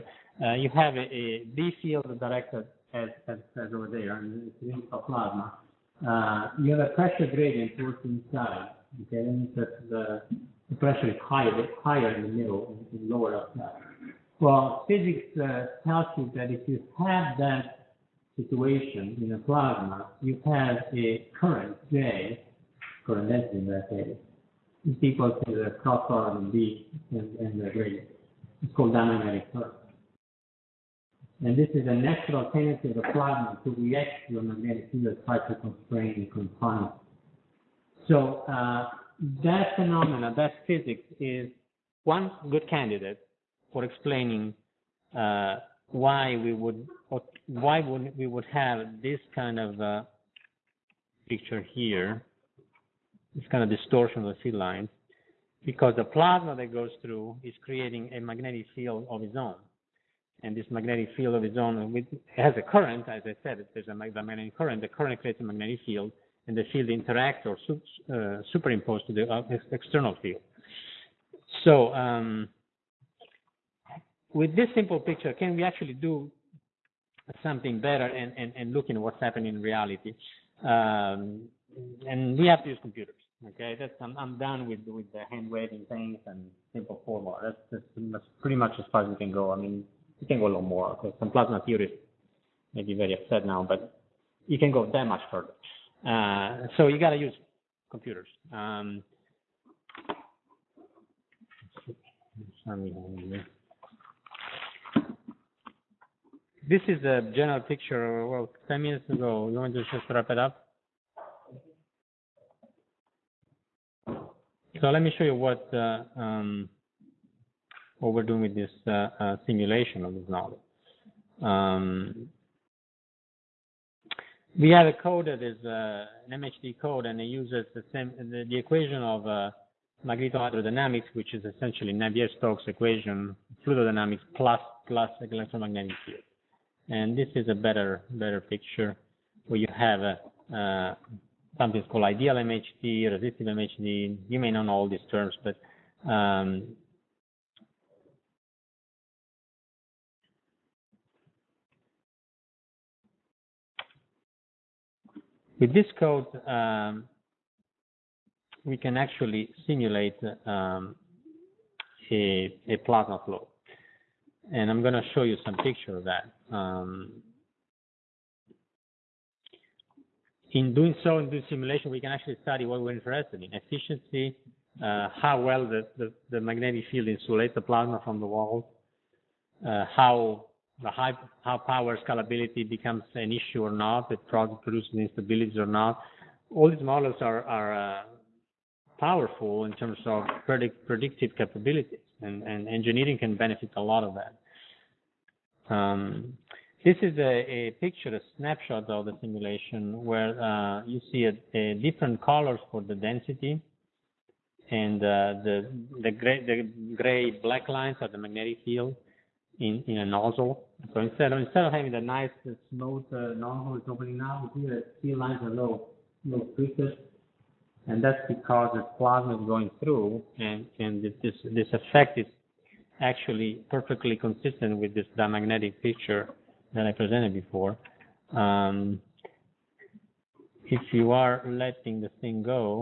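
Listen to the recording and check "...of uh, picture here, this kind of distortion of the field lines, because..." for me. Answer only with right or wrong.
right.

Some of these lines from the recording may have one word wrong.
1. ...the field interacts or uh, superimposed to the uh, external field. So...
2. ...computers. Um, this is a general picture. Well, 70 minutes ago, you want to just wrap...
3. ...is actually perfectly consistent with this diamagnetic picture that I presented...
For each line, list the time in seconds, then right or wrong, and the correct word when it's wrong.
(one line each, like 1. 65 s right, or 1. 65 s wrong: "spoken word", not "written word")
1. 66 s right
2. 97 s wrong: "10", not "70"
3. 222 s right.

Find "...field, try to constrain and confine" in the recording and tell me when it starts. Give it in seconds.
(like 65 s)
34 s.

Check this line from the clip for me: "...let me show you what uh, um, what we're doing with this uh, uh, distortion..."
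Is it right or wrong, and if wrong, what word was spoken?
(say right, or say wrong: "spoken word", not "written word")
wrong: "simulation", not "distortion".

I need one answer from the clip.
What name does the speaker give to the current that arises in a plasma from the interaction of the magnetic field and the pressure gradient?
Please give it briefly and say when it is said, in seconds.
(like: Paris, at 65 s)
Diamagnetic current, at 28 s.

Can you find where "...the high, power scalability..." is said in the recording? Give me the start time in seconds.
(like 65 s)
180 s.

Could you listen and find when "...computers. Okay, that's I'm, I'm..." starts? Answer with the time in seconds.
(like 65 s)
82 s.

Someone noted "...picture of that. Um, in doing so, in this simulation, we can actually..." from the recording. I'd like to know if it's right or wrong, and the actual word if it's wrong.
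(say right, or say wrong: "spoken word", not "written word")
right.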